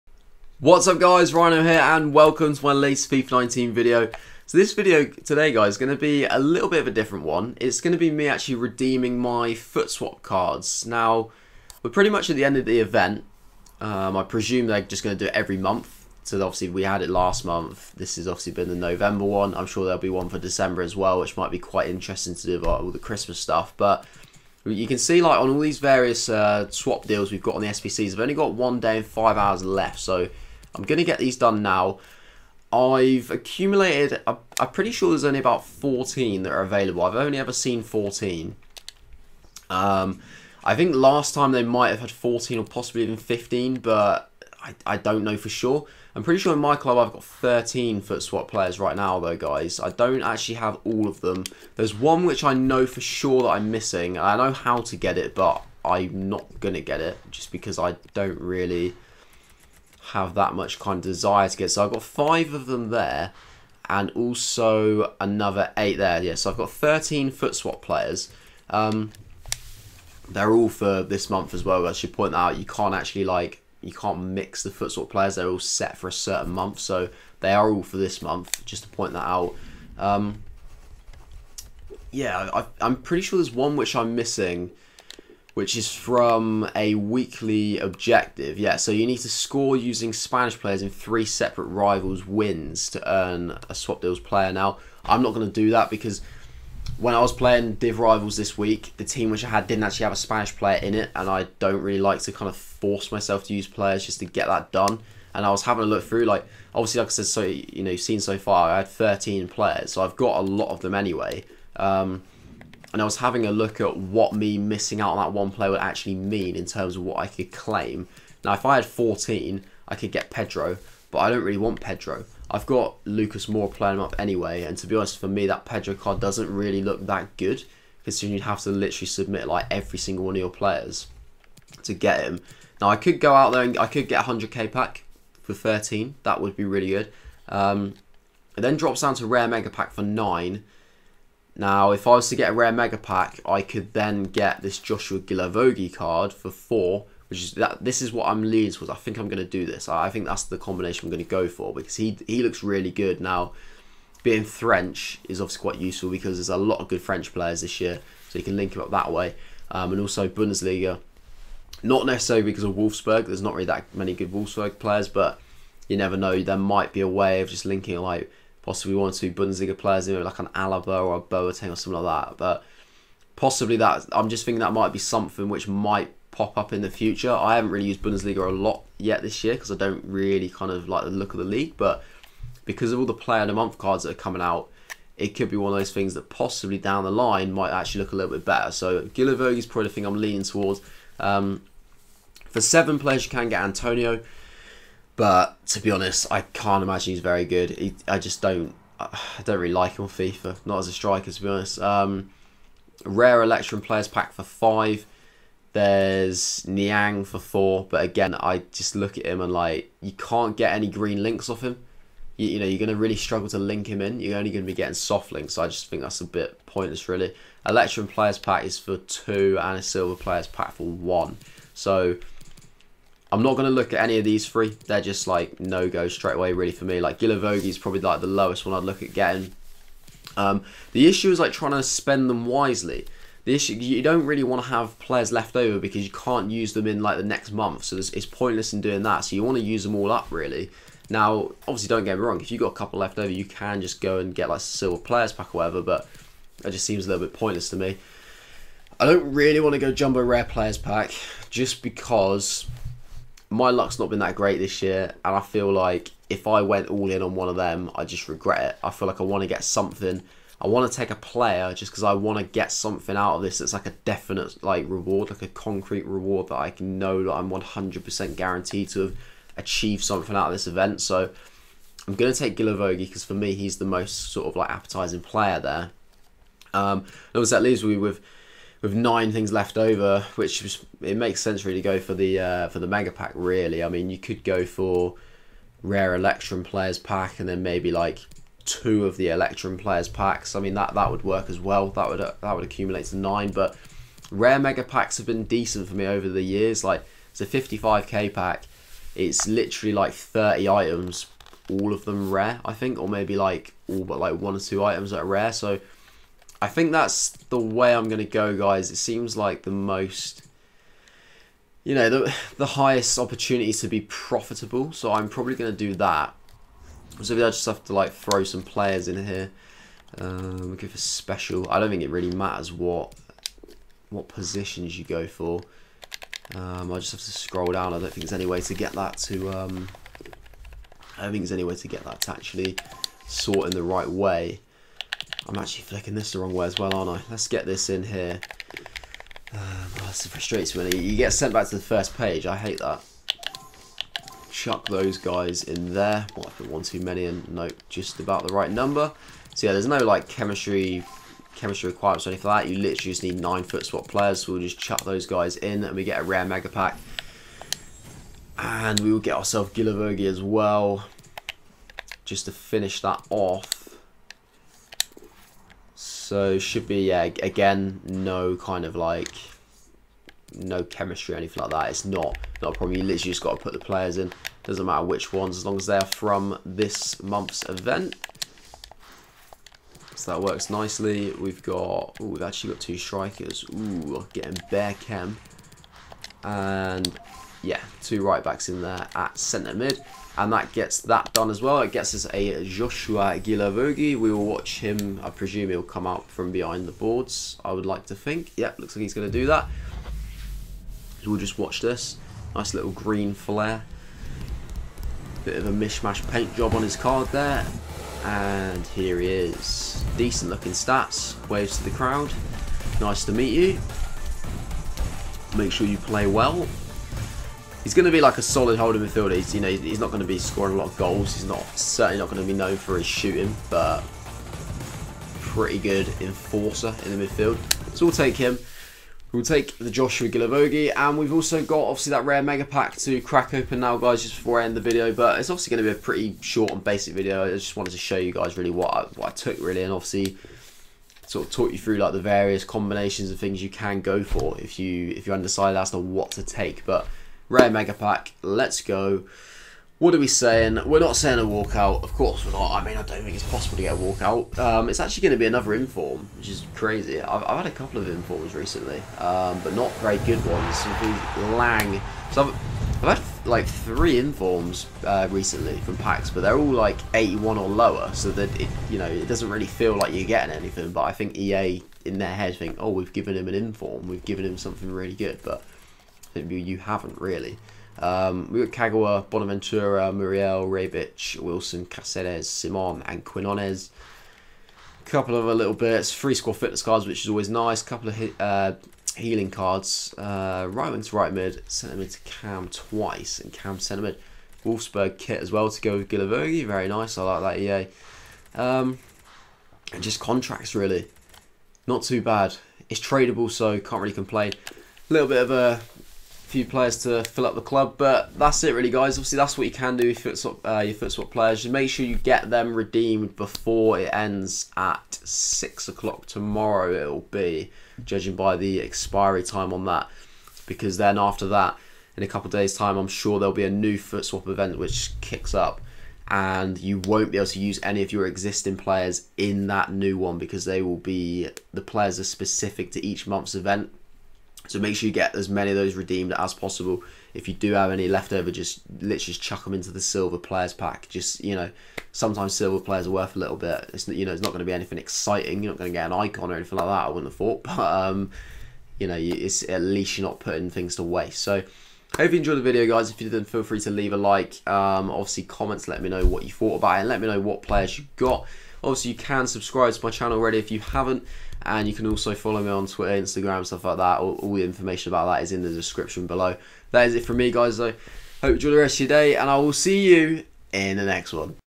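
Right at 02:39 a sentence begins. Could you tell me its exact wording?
Um, and also Bundesliga, not necessarily because of Wolfsburg.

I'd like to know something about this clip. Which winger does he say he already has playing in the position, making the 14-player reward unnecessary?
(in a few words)
Lucas Moura.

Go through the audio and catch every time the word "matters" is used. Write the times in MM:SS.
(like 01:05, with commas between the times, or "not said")
05:22, 06:14.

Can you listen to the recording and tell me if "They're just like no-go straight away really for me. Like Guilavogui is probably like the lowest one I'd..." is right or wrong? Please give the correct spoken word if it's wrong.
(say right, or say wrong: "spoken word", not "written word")
right.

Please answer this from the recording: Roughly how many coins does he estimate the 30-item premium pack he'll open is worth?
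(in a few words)
55k.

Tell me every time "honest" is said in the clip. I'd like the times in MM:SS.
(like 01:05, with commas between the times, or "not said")
02:04, 03:15, 03:21.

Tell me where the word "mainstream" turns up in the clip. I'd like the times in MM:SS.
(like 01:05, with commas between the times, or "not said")
not said.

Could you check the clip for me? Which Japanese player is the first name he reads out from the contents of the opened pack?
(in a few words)
Kagawa.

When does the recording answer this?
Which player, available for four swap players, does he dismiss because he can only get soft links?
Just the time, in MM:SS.
03:26.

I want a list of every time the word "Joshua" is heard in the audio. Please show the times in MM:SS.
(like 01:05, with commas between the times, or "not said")
02:24, 06:32, 07:09.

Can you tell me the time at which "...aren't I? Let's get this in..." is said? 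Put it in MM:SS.
05:36.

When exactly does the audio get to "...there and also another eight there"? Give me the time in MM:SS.
01:02.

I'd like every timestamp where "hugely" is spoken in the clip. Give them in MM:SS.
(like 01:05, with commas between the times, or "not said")
not said.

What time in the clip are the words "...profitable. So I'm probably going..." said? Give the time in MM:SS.
05:14.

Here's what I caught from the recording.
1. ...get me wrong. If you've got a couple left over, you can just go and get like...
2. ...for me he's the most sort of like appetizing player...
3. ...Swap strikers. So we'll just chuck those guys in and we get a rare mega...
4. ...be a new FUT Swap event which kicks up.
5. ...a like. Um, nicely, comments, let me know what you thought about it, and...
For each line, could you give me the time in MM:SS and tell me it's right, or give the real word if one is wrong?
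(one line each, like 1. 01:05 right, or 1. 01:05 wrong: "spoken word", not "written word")
1. 04:02 right
2. 04:33 right
3. 05:53 wrong: "players", not "strikers"
4. 08:43 right
5. 09:14 wrong: "obviously", not "nicely".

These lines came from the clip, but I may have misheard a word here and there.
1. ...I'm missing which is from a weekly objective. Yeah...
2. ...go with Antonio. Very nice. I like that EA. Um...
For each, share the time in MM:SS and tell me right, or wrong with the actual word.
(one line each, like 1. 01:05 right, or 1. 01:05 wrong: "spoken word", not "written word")
1. 01:23 right
2. 08:15 wrong: "Guilavogui", not "Antonio".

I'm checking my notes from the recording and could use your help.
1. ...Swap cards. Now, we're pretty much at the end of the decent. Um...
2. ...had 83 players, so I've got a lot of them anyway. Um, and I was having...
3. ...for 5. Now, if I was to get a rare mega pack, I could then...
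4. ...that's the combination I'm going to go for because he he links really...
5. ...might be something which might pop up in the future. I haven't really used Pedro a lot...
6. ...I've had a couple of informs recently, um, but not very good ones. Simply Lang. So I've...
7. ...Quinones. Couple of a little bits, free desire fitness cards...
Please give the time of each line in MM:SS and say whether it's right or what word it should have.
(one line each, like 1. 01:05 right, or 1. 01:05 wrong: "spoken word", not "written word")
1. 00:09 wrong: "event", not "decent"
2. 01:48 wrong: "13", not "83"
3. 02:19 wrong: "9", not "5"
4. 02:30 wrong: "looks", not "links"
5. 02:54 wrong: "Bundesliga", not "Pedro"
6. 07:37 right
7. 08:03 wrong: "score", not "desire".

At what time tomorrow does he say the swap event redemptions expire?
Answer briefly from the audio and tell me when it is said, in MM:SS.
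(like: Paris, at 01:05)
6 o'clock, at 08:35.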